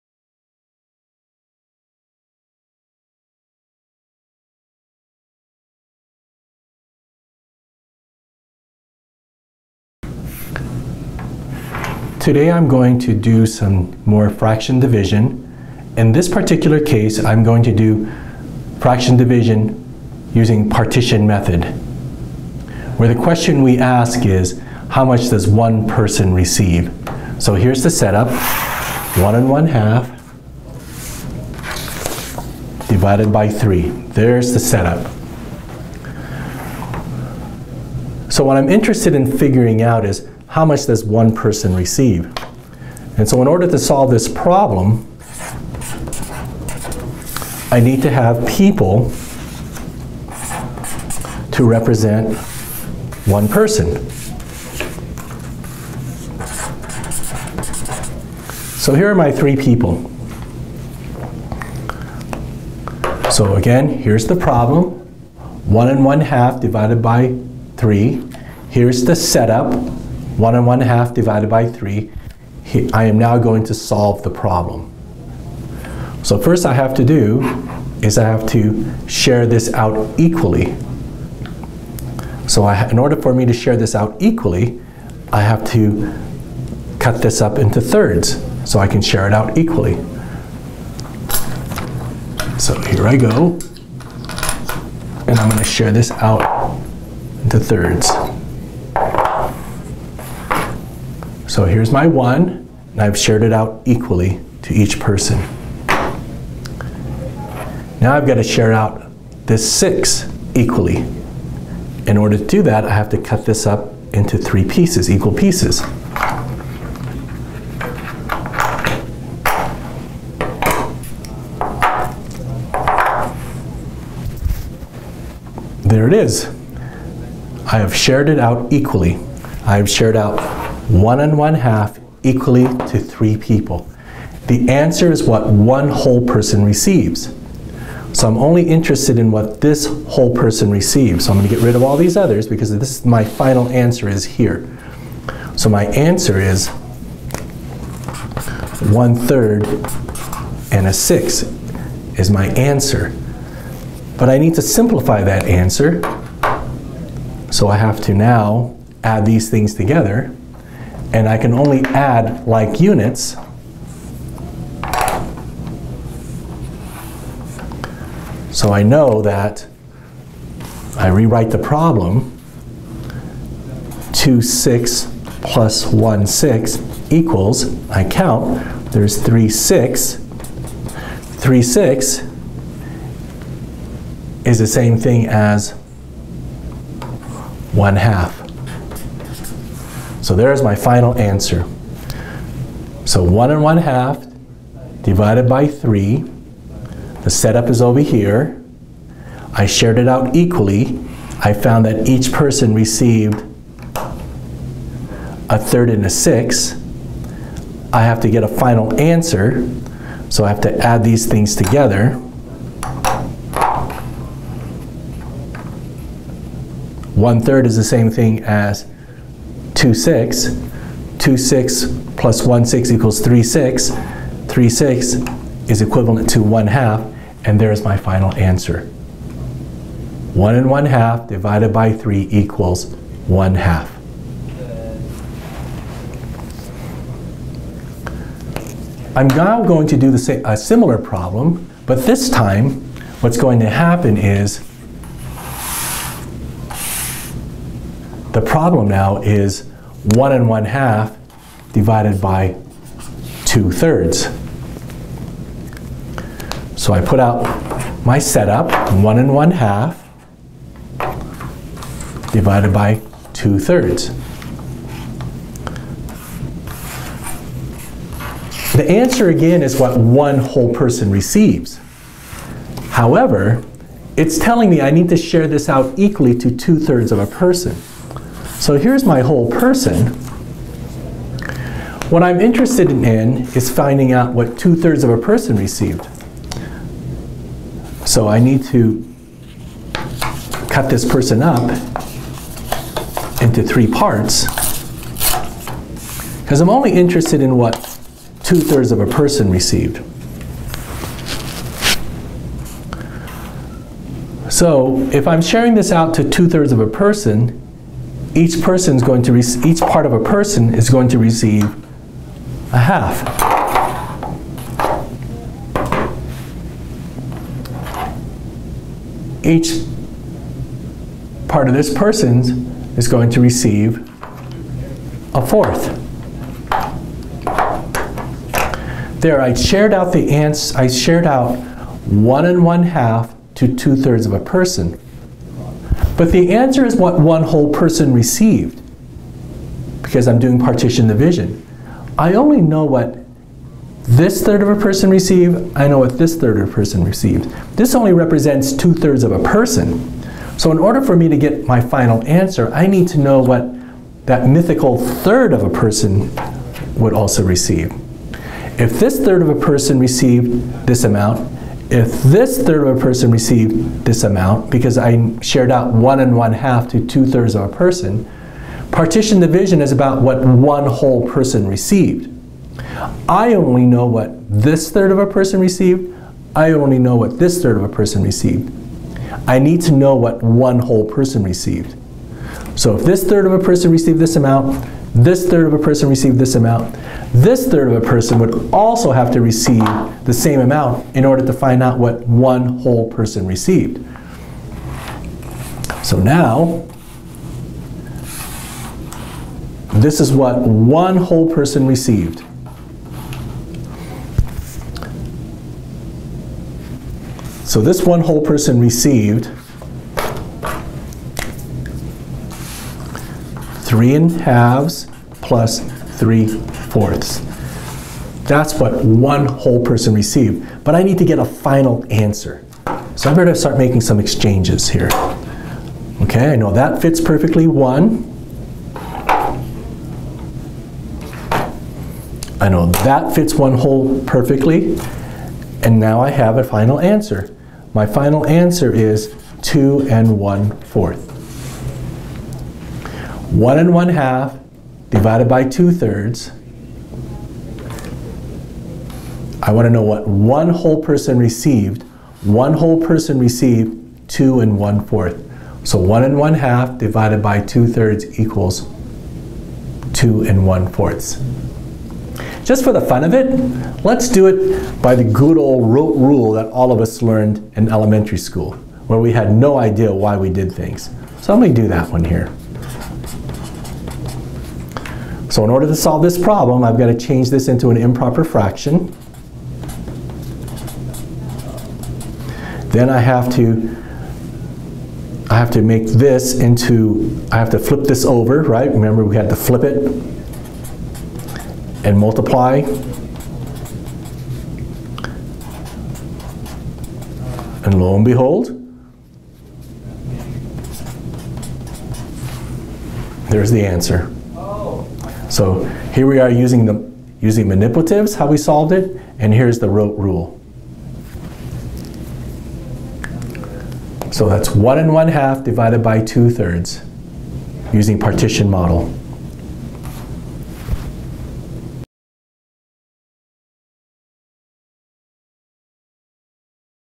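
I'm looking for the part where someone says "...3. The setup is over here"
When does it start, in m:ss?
3:15.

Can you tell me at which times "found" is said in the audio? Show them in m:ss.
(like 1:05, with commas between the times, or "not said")
3:21.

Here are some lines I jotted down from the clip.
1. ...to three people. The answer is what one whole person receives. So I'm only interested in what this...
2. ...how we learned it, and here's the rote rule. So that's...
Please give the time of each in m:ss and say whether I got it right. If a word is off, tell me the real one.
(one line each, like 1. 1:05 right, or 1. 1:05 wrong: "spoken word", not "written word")
1. 2:12 right
2. 8:28 wrong: "solved", not "learned".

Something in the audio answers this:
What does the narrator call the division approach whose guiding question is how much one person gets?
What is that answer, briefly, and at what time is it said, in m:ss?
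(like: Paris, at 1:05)
partition method, at 0:20.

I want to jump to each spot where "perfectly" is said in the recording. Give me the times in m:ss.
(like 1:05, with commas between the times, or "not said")
7:07, 7:14.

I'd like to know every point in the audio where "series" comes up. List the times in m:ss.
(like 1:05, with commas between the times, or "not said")
not said.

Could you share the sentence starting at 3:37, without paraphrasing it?
One third is the same thing as 2, 6.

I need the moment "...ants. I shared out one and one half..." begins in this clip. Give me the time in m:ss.
5:30.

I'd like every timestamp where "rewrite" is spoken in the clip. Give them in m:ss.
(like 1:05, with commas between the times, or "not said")
2:51.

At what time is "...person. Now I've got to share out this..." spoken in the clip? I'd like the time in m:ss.
1:45.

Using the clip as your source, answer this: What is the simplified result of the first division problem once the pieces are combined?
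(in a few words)
1 half.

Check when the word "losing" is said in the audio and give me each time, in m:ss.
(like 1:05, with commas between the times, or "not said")
not said.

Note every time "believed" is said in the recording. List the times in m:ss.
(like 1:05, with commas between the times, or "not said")
not said.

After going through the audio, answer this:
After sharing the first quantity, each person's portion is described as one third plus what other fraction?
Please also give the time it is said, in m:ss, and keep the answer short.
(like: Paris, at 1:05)
a sixth, at 3:25.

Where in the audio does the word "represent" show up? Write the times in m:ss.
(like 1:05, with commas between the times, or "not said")
0:51, 5:48.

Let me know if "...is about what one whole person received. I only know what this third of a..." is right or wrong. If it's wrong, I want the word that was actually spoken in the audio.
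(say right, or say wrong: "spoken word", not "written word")
right.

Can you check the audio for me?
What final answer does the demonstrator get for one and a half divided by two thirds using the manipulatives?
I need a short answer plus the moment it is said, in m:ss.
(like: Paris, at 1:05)
2 and 1 fourth, at 7:34.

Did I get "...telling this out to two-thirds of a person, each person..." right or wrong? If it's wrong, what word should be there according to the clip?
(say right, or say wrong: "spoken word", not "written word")
wrong: "sharing", not "telling".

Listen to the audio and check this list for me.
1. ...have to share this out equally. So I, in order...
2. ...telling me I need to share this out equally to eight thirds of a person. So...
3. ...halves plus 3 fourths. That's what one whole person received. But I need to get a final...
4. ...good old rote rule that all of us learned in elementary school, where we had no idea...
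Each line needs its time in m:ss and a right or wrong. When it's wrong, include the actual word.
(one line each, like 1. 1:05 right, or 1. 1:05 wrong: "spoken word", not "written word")
1. 1:18 right
2. 4:34 wrong: "two", not "eight"
3. 6:54 right
4. 7:45 right.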